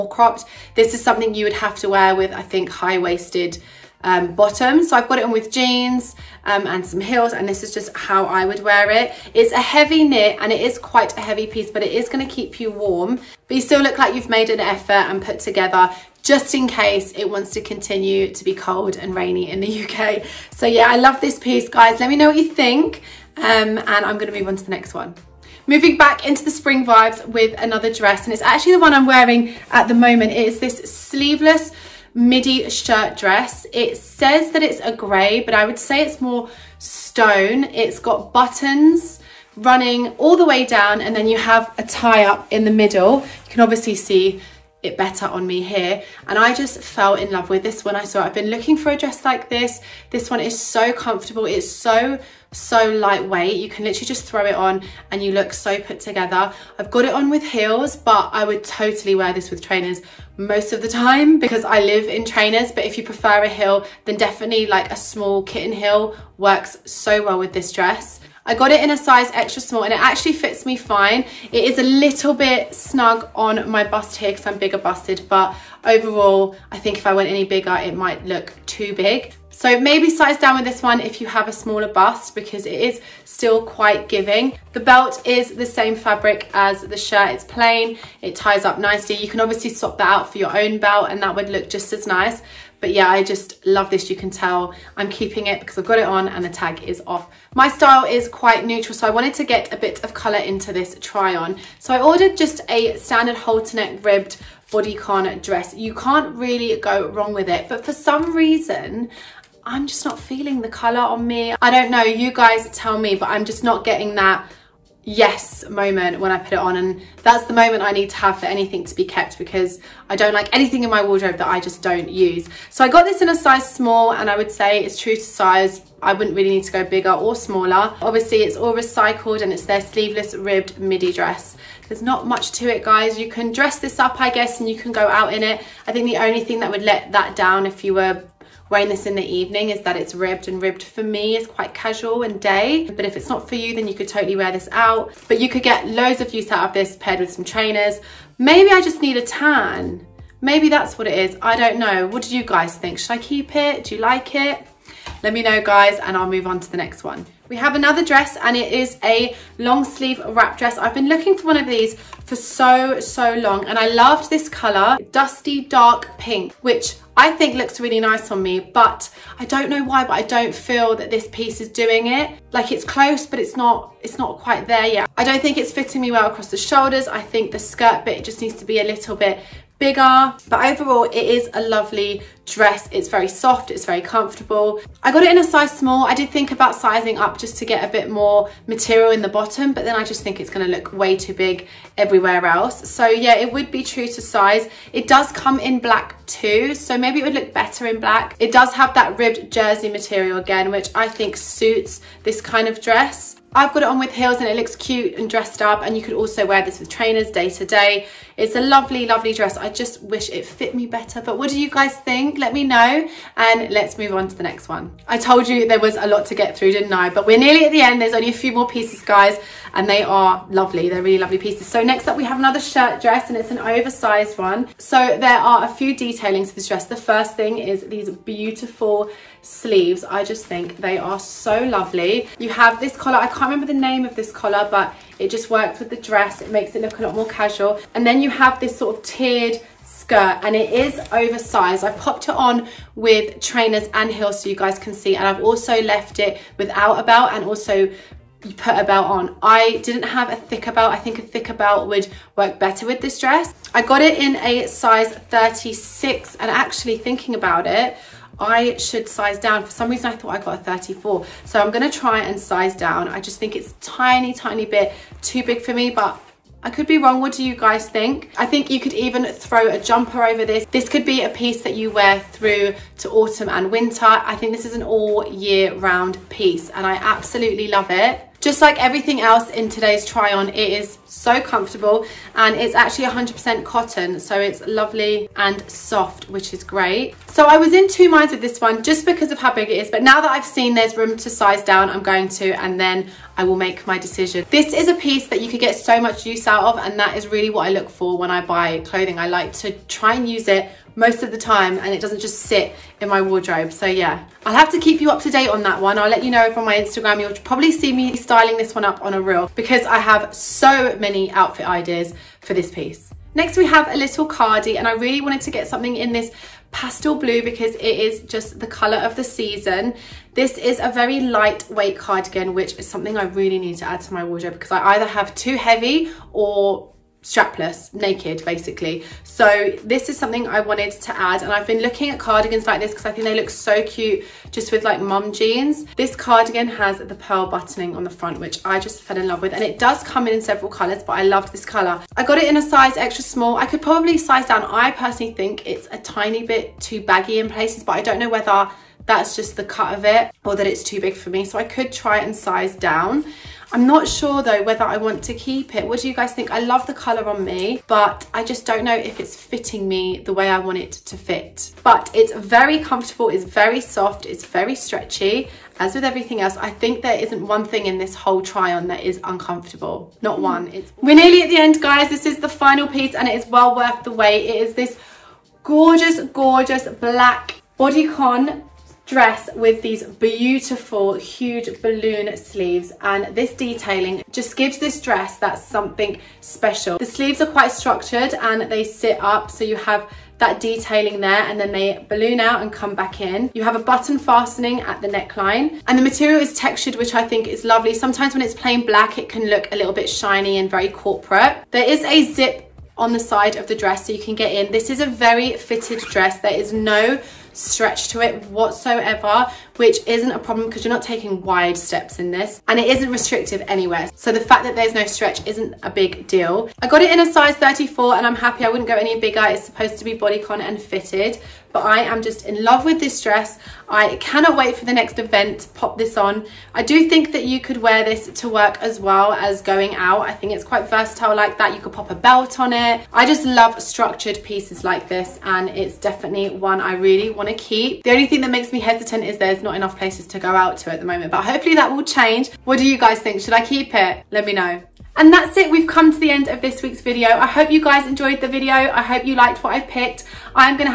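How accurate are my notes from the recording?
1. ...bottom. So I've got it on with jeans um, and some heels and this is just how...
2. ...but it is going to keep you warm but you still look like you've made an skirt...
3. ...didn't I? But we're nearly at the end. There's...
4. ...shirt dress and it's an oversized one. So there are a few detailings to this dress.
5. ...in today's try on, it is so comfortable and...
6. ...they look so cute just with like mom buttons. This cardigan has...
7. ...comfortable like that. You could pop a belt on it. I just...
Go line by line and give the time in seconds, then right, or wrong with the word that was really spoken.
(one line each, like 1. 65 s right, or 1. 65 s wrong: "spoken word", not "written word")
1. 4 s right
2. 11 s wrong: "effort", not "skirt"
3. 216 s right
4. 222 s right
5. 279 s right
6. 333 s wrong: "jeans", not "buttons"
7. 430 s wrong: "versatile", not "comfortable".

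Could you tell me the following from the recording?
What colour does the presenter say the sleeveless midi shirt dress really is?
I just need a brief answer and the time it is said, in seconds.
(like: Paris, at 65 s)
stone, at 36 s.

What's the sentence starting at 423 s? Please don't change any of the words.
I cannot wait for the next event pop this on.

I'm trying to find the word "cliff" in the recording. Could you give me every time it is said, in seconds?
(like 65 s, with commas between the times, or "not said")
not said.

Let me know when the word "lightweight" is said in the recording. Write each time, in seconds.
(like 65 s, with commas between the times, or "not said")
52 s, 321 s.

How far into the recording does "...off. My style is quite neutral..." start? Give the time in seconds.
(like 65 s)
97 s.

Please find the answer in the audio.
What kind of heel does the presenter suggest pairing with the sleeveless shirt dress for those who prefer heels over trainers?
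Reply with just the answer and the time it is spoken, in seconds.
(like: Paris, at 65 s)
kitten heel, at 65 s.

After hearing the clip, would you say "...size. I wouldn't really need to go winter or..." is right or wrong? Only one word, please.
wrong.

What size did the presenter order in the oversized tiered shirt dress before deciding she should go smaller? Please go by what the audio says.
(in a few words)
36.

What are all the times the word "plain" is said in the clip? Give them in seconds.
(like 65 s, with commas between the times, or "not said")
87 s, 398 s.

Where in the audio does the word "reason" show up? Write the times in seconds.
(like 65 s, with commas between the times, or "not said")
108 s, 259 s.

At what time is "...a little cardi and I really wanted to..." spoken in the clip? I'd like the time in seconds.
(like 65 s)
313 s.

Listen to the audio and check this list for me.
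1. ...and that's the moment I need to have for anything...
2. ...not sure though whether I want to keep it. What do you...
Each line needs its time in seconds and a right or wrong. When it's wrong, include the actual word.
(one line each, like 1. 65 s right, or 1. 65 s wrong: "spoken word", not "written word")
1. 116 s right
2. 353 s right.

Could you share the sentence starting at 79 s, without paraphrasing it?
So maybe size down with this one if you have a smaller bust because it is still quite giving.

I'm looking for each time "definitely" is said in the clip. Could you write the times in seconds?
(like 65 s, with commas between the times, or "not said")
64 s, 435 s.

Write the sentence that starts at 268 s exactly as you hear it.
I think you could even throw a jumper over this.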